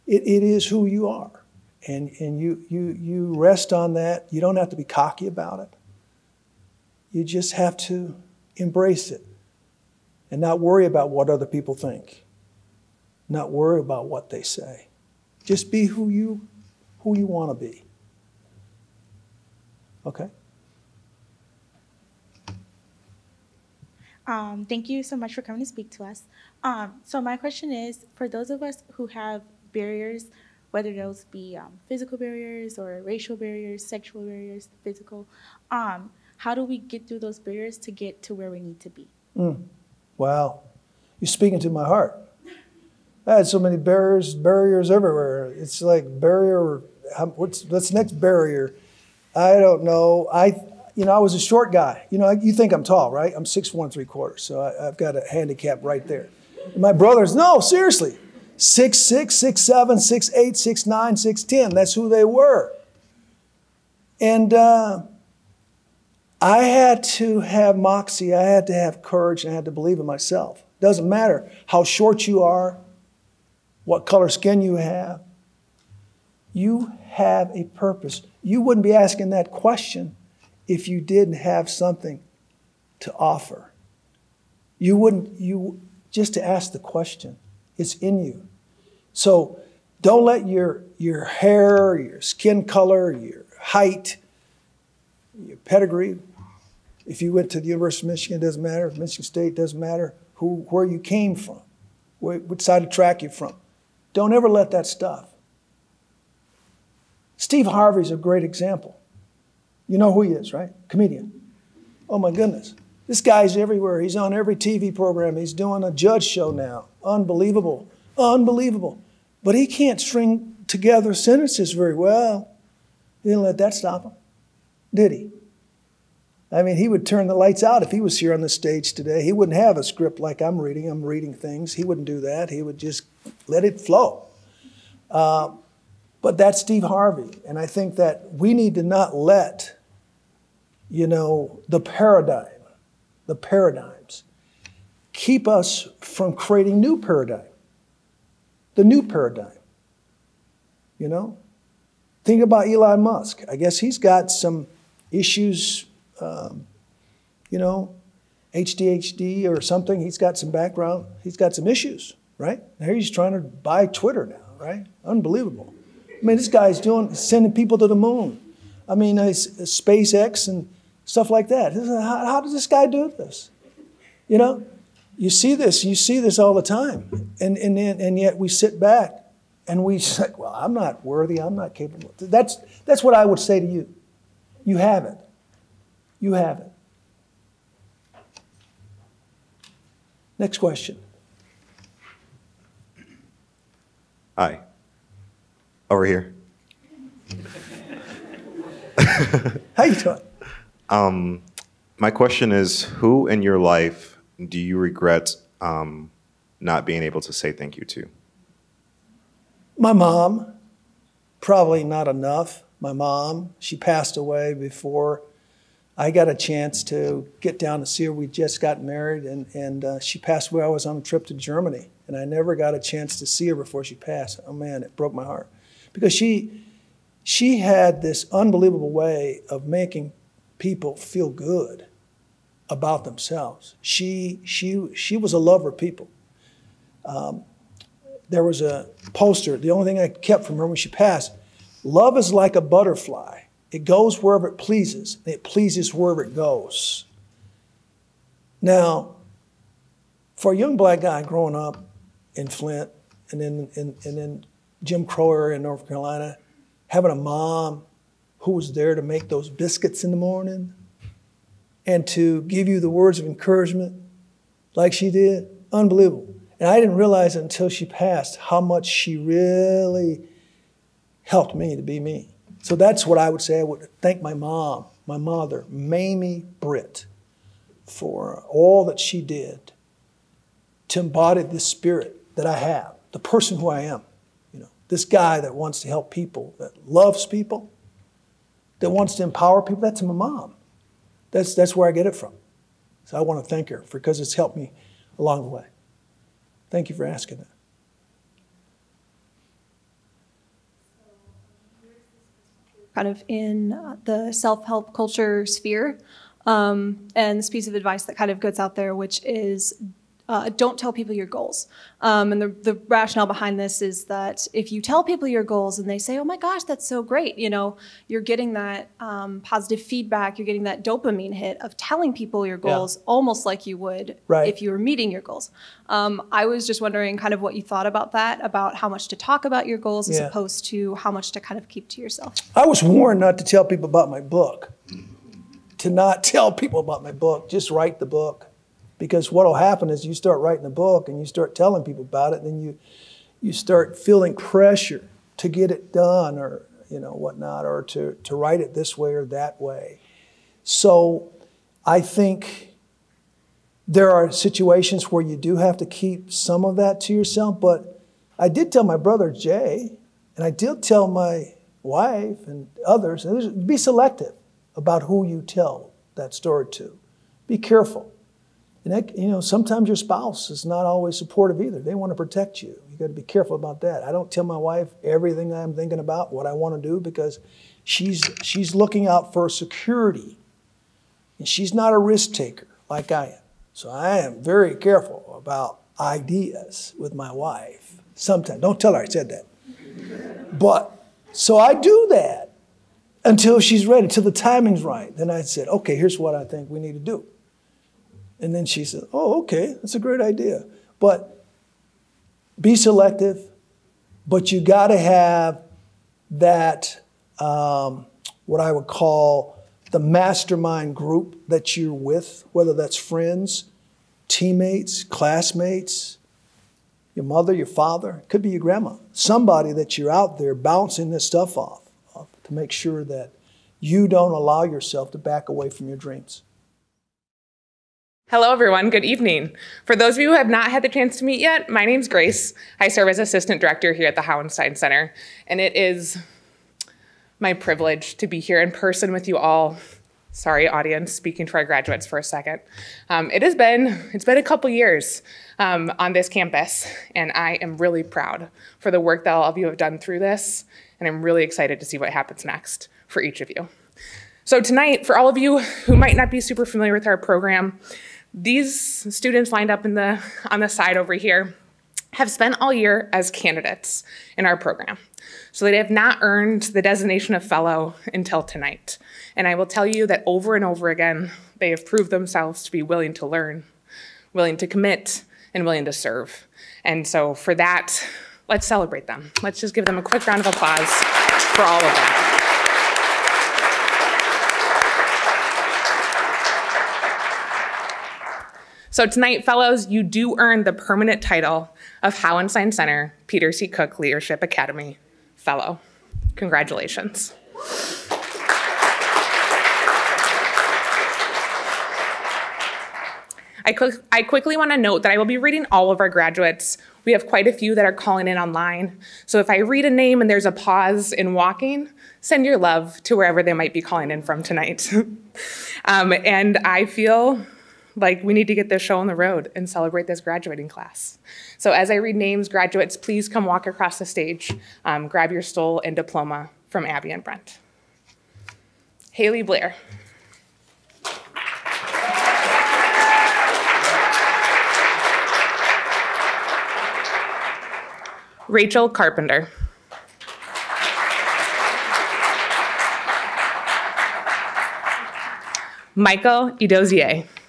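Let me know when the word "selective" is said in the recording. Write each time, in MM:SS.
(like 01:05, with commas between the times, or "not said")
06:03, 06:42.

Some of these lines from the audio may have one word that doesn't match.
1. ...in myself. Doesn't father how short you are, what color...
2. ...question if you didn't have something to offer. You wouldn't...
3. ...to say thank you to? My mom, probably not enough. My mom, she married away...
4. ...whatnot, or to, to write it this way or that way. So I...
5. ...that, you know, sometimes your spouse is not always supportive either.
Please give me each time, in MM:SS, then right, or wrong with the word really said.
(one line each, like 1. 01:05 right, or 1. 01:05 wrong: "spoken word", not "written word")
1. 01:09 wrong: "matter", not "father"
2. 01:19 right
3. 03:27 wrong: "passed", not "married"
4. 05:47 right
5. 06:08 right.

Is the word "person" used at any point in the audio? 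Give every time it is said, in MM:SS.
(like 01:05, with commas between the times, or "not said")
04:43, 07:18.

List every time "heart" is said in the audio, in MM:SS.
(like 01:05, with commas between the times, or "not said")
00:41, 03:45.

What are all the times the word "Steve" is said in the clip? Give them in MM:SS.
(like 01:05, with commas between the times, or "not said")
01:47, 02:16.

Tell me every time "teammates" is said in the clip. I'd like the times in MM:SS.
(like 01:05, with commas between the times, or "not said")
06:54.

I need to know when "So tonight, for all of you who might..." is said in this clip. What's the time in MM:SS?
07:34.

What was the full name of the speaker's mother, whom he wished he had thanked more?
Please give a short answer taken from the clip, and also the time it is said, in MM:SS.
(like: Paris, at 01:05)
Mamie Britt, at 04:35.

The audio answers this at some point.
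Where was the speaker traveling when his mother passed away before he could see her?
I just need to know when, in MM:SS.
03:41.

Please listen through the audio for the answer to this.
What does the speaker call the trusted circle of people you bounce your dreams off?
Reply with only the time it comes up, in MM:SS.
06:49.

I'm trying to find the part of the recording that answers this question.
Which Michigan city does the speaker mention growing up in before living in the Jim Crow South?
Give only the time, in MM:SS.
04:12.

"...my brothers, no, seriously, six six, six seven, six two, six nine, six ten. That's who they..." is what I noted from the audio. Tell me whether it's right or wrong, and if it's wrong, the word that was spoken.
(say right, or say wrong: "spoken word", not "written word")
wrong: "eight", not "two".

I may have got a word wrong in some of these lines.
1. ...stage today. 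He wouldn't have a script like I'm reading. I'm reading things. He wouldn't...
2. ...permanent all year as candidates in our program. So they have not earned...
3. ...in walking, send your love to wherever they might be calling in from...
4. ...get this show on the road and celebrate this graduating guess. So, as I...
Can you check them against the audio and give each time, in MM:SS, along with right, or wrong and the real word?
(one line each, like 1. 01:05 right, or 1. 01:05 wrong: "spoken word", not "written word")
1. 02:08 right
2. 07:42 wrong: "spent", not "permanent"
3. 08:31 right
4. 08:38 wrong: "class", not "guess".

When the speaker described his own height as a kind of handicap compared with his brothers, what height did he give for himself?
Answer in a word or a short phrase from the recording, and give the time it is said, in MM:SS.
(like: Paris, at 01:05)
6'1¾", at 00:53.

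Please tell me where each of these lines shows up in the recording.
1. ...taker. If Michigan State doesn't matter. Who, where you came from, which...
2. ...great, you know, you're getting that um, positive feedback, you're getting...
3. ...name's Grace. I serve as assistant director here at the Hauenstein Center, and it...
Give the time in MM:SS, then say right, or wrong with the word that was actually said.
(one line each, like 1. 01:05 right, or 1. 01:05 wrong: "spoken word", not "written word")
1. 01:38 wrong: "matter", not "taker"
2. 05:17 right
3. 07:11 right.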